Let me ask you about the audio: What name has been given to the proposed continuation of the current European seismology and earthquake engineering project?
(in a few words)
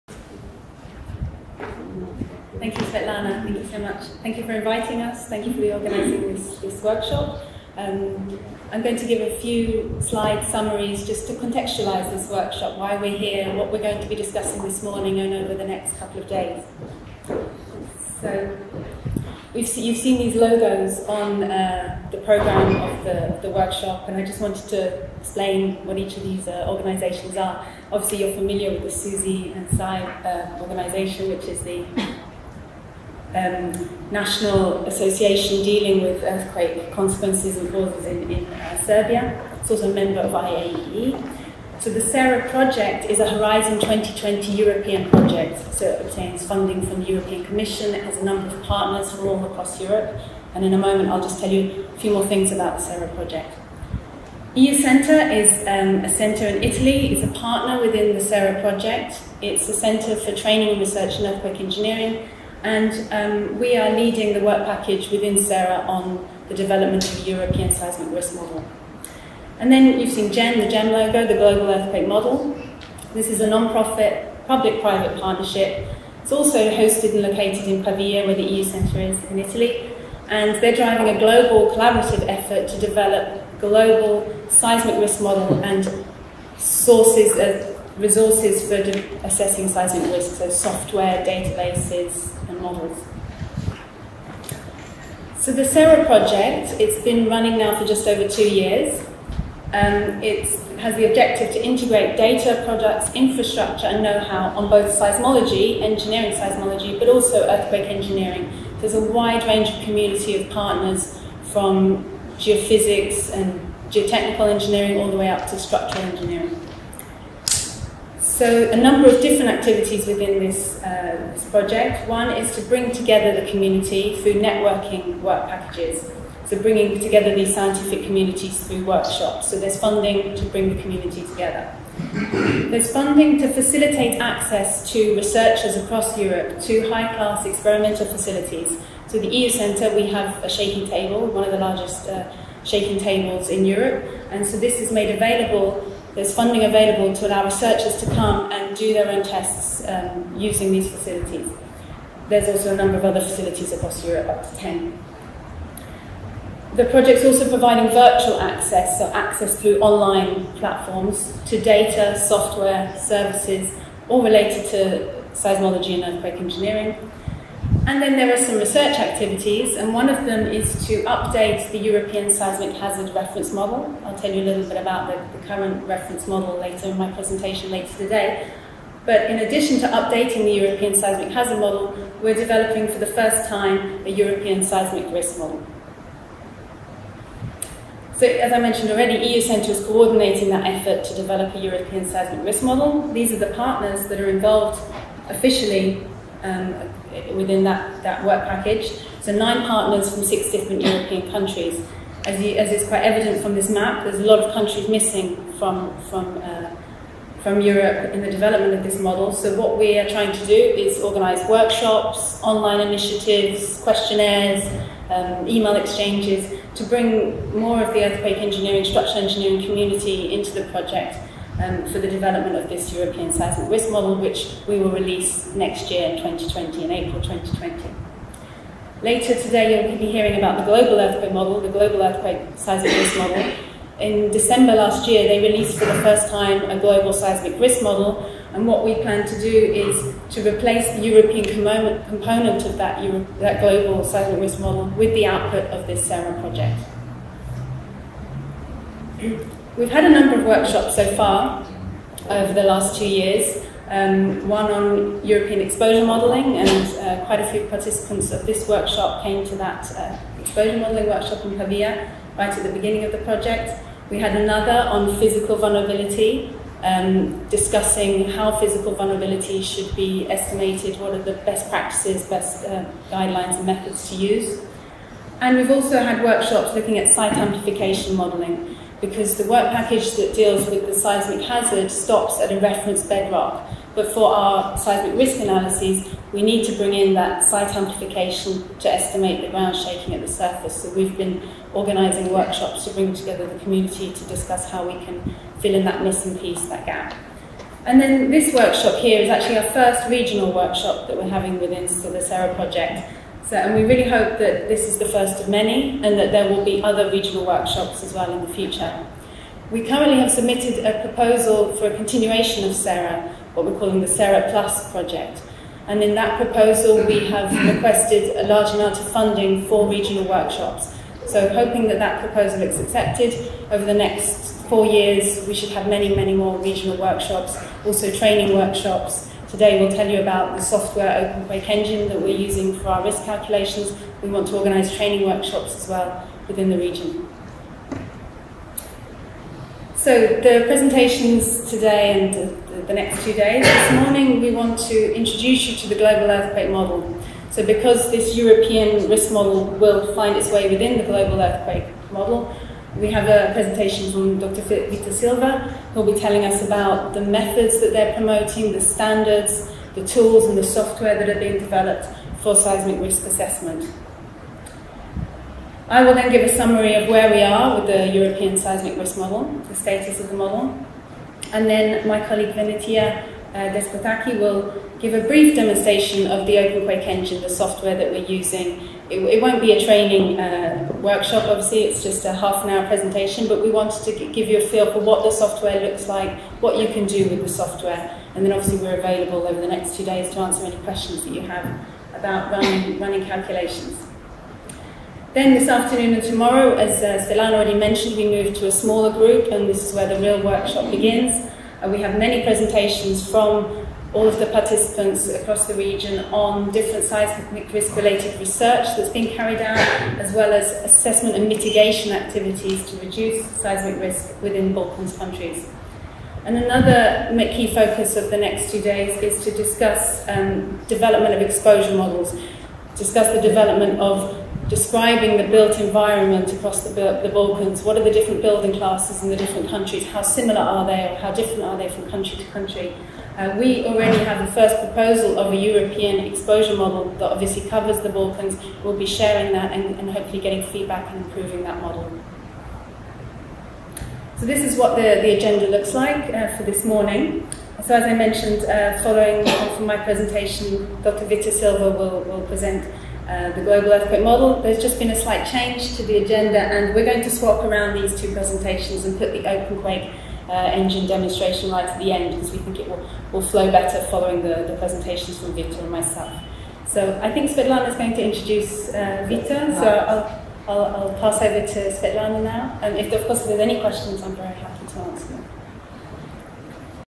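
SERA Plus.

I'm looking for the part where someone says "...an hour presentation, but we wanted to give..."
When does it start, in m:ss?
6:22.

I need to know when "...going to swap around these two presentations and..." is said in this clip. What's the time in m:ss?
7:37.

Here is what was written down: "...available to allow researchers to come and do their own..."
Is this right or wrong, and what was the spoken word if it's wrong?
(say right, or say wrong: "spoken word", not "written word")
right.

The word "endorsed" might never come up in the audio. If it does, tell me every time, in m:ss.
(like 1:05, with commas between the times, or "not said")
not said.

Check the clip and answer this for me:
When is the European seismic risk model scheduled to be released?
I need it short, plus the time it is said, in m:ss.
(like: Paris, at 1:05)
April 2020, at 3:46.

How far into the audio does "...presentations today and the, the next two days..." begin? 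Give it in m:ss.
5:40.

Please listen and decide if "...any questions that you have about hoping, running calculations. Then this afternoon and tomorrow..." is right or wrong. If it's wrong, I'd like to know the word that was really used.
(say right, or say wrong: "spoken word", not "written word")
wrong: "running", not "hoping".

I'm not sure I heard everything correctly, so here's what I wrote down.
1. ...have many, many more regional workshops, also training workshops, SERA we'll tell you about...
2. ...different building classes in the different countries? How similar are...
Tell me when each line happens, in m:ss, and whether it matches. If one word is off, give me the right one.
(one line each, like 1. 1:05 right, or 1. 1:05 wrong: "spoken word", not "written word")
1. 5:25 wrong: "Today", not "SERA"
2. 7:08 right.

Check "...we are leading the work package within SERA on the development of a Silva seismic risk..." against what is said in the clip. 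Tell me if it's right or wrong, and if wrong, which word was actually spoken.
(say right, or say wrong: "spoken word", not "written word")
wrong: "European", not "Silva".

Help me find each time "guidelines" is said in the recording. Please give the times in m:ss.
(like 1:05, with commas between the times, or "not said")
4:33.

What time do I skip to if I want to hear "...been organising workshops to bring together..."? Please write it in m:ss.
4:51.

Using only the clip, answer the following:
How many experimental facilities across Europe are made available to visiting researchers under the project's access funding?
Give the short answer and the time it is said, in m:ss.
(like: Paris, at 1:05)
10, at 2:34.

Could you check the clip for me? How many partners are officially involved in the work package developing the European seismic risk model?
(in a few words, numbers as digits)
9.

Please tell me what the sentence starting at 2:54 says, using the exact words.
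I'll tell you a little bit about the, the, current reference model later in my presentation later today.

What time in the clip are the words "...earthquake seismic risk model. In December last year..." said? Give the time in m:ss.
3:52.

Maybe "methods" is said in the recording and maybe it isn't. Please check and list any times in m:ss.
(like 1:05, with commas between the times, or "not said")
4:33, 5:57.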